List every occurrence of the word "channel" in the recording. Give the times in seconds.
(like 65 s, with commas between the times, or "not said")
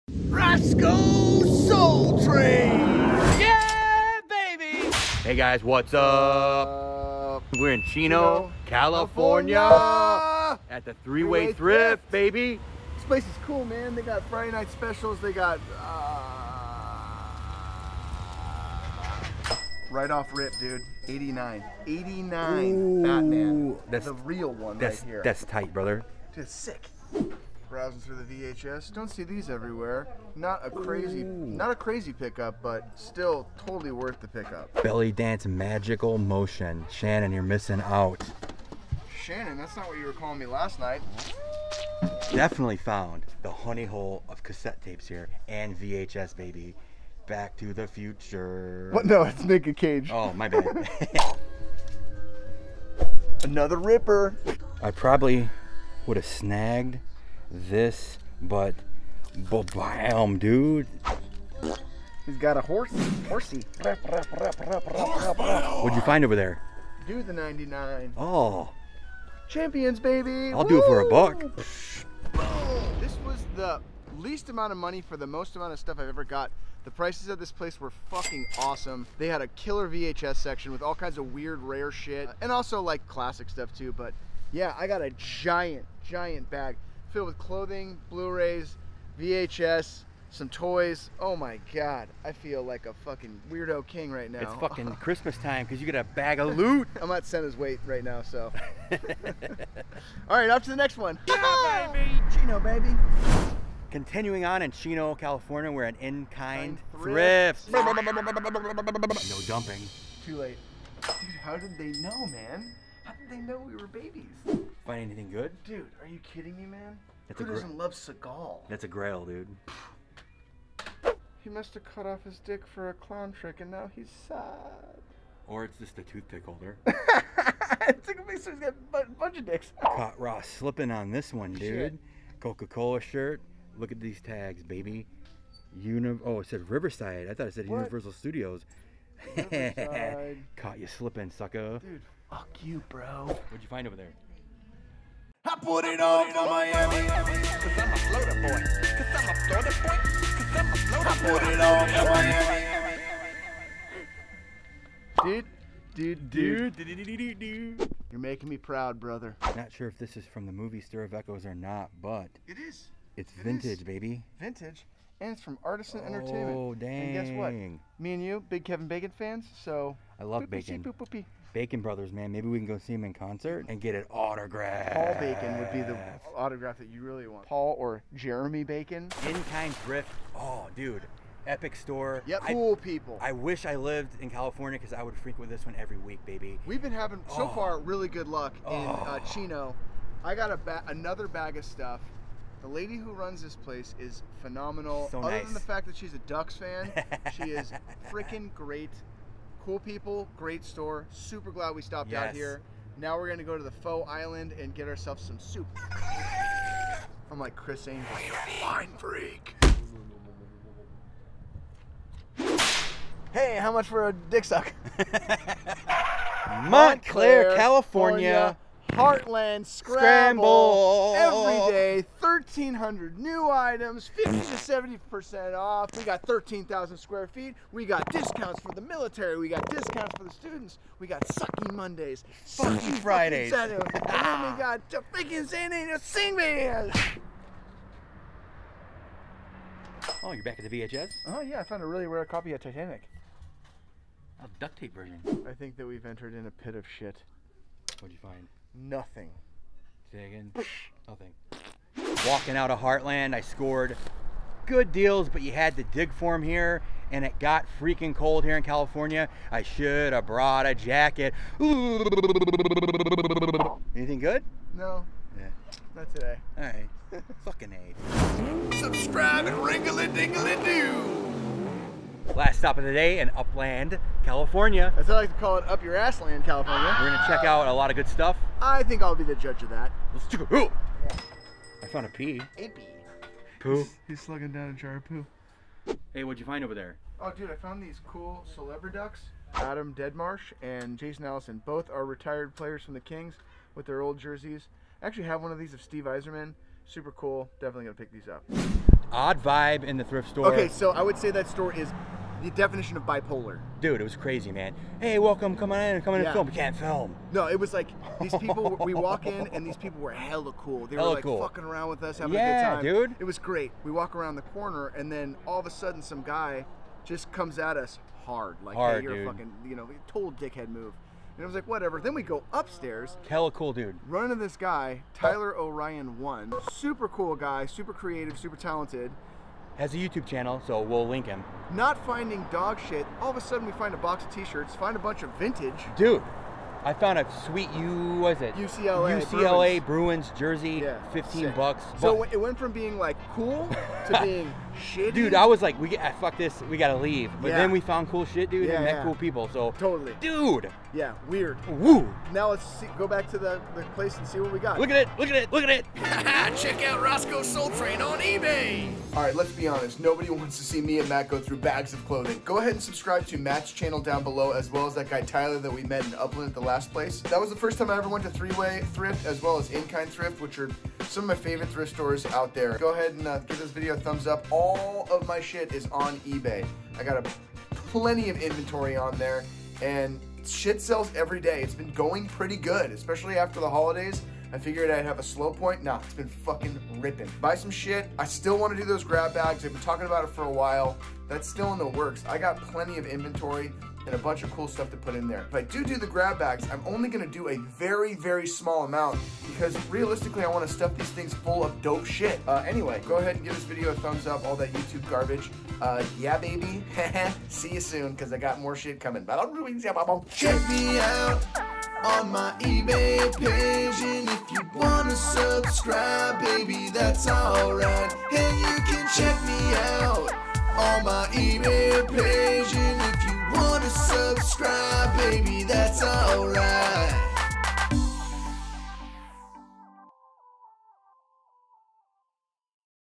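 330 s, 363 s.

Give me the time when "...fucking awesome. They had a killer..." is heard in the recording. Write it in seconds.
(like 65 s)
78 s.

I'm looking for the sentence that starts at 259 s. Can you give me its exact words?
I should have brought a jacket.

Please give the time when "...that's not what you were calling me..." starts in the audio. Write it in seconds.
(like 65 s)
39 s.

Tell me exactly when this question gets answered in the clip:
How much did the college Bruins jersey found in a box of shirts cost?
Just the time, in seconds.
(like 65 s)
341 s.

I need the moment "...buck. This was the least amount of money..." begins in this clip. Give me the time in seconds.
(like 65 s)
71 s.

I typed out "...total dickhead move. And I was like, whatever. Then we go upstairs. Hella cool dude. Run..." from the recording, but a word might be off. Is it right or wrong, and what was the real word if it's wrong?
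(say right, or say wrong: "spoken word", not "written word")
right.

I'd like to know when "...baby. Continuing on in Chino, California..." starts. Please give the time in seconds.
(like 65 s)
102 s.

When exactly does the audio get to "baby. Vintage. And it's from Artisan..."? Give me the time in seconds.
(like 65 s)
163 s.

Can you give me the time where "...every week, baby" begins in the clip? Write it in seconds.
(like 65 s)
185 s.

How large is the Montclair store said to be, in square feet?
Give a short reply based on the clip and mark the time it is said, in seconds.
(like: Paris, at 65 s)
13,000 square feet, at 226 s.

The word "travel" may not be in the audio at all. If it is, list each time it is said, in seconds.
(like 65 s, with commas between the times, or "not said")
not said.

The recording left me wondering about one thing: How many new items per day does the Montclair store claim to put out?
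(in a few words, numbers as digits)
1,300.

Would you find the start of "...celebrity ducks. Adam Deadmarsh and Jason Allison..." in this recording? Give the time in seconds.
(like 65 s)
288 s.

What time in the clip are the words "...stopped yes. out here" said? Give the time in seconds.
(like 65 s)
201 s.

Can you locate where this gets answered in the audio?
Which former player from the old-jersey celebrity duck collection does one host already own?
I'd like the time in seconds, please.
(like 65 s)
295 s.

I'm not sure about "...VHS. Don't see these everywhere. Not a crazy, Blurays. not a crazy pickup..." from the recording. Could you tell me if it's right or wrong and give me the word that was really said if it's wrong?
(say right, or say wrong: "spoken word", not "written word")
wrong: "Ooh", not "Blurays".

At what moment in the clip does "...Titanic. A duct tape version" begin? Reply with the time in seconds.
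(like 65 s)
242 s.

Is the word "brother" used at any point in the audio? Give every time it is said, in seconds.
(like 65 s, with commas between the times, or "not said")
25 s, 158 s, 171 s.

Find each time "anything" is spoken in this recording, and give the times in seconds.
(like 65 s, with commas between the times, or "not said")
115 s, 263 s.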